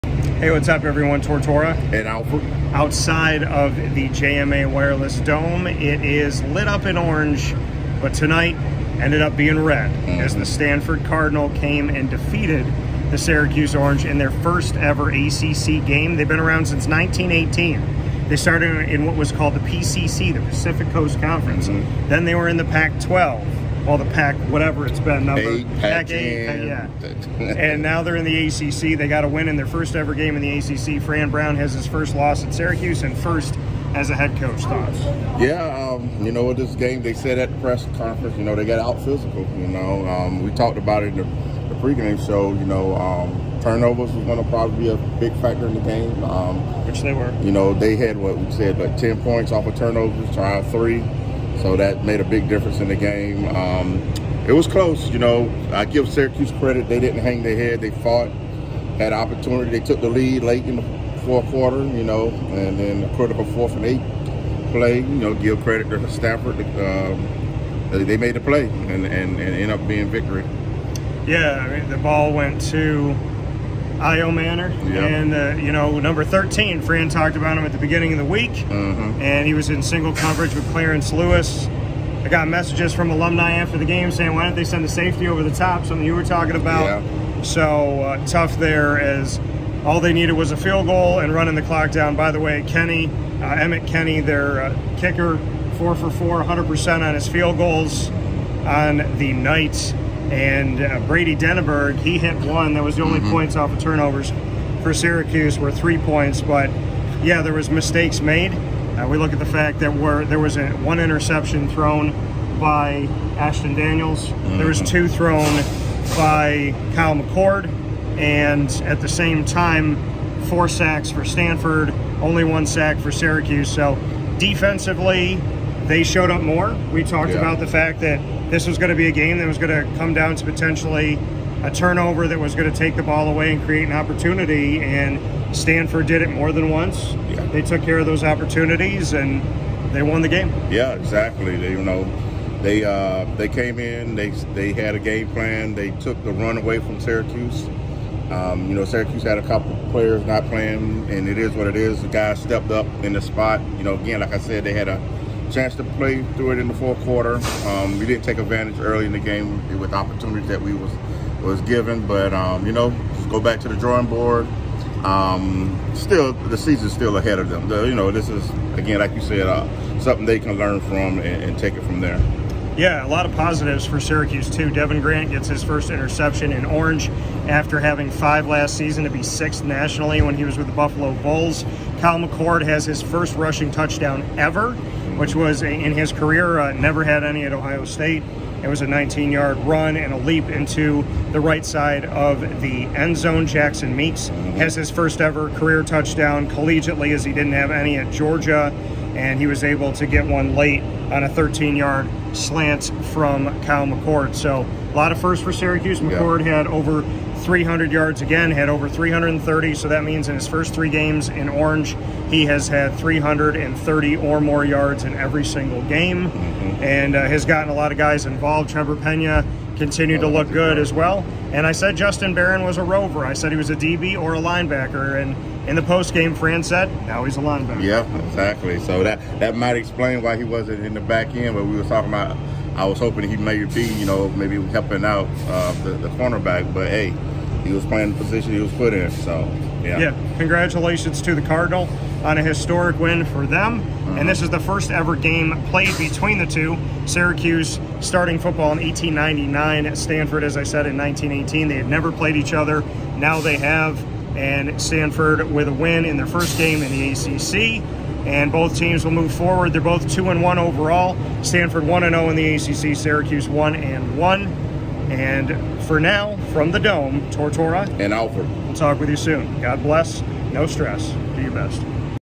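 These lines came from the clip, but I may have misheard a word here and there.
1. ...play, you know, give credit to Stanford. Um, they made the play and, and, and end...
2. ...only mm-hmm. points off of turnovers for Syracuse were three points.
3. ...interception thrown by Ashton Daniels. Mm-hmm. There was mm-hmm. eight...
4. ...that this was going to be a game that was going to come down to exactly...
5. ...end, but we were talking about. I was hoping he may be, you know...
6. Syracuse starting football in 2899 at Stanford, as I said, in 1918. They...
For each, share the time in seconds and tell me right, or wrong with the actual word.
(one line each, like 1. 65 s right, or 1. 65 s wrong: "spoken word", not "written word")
1. 64 s right
2. 103 s right
3. 110 s wrong: "two", not "eight"
4. 127 s wrong: "potentially", not "exactly"
5. 231 s right
6. 247 s wrong: "1899", not "2899".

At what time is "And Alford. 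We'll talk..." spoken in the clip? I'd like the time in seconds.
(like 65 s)
267 s.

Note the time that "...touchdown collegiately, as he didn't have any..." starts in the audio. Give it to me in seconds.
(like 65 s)
195 s.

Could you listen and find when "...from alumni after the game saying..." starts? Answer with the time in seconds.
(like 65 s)
82 s.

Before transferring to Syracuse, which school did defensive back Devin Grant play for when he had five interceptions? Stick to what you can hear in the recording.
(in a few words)
Buffalo.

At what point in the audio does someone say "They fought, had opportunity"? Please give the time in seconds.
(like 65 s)
57 s.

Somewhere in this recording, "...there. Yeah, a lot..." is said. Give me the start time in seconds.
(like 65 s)
171 s.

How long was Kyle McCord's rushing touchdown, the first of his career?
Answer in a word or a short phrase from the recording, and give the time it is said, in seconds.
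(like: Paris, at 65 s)
19 yards, at 188 s.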